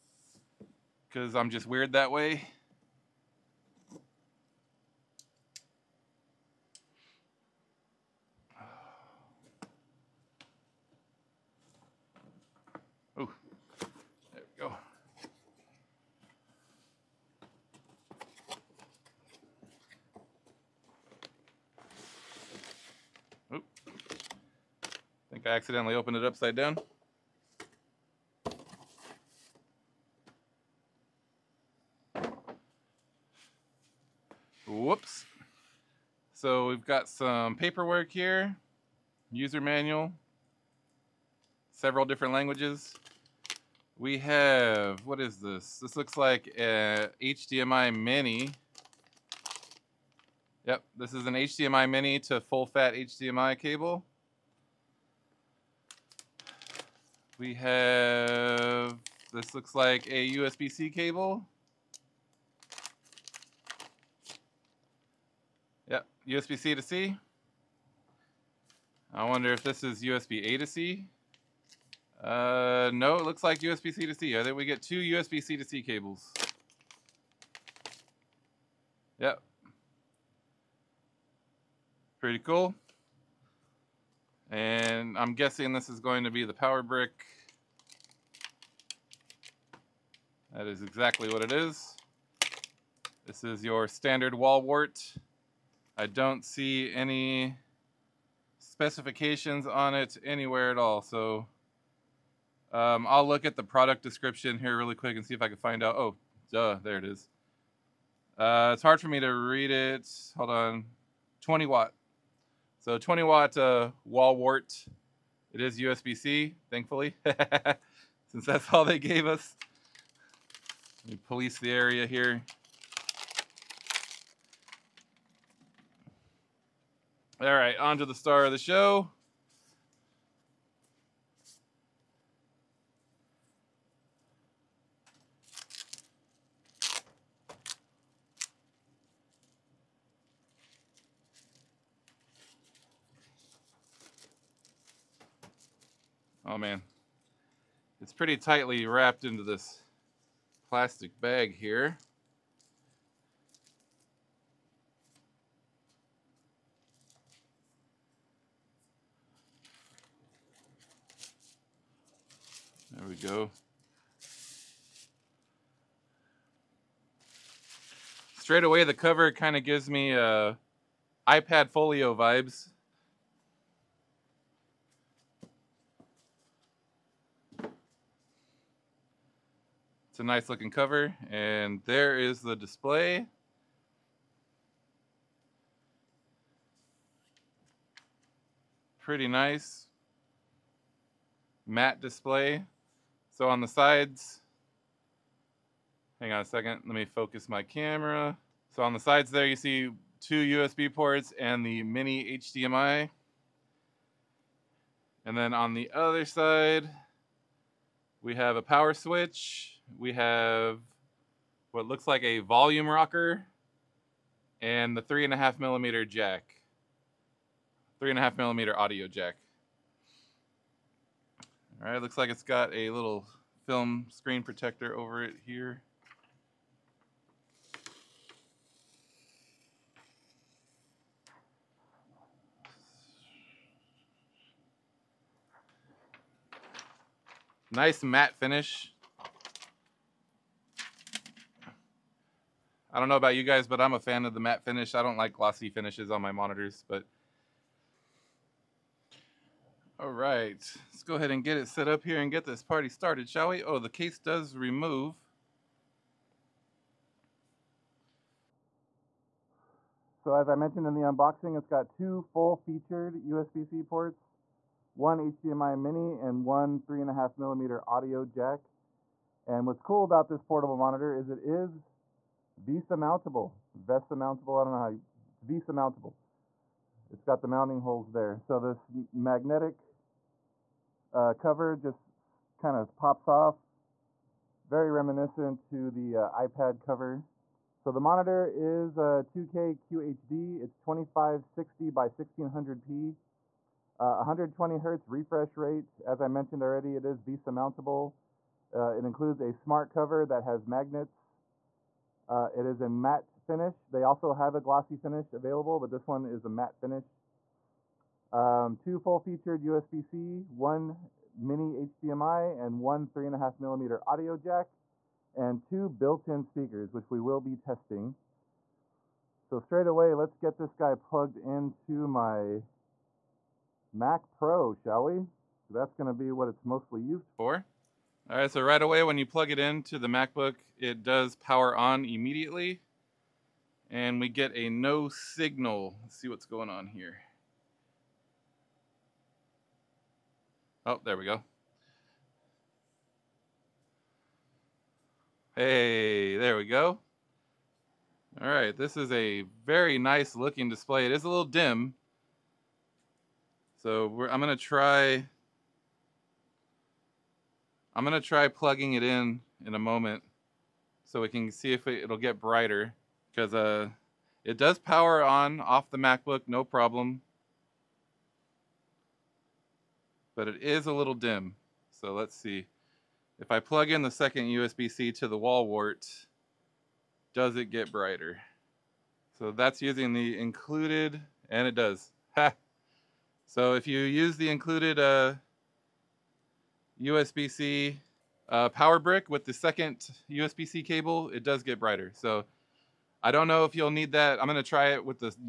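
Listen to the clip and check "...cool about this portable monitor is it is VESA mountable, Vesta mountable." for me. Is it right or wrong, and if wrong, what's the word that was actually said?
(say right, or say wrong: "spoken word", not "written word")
right.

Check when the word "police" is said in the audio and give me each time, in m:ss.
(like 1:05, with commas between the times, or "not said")
2:01.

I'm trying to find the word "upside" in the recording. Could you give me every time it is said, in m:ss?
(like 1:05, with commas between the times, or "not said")
0:26.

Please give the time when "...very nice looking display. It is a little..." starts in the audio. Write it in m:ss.
5:49.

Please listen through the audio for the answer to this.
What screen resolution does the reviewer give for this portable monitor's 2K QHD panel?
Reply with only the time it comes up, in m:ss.
4:50.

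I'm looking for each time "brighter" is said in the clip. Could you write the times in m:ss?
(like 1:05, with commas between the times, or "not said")
6:02, 6:17, 6:31.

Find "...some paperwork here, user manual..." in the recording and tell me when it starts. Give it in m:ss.
0:37.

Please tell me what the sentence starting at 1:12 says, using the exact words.
Uh, no, it looks like USB-C to C.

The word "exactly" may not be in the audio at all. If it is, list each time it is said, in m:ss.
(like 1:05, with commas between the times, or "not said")
1:30.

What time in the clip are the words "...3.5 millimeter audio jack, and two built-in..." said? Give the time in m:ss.
5:13.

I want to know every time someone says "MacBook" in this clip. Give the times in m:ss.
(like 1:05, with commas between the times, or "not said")
5:30, 6:05.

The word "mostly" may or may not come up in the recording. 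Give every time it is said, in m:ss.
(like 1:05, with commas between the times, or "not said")
5:26.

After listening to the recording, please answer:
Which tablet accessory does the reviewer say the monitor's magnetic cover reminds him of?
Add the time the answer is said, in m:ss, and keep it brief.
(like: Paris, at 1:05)
iPad Folio, at 2:51.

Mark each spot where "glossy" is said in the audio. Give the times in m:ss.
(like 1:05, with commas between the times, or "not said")
4:05, 5:04.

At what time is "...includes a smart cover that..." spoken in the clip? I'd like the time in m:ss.
4:59.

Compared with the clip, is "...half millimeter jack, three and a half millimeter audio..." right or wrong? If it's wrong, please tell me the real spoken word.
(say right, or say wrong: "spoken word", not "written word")
right.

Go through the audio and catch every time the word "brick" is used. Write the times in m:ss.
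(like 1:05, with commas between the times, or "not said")
1:26, 6:28.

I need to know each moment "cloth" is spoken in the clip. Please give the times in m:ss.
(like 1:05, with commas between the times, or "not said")
not said.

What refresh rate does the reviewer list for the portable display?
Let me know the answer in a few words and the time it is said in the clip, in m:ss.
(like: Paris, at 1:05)
120 hertz, at 4:54.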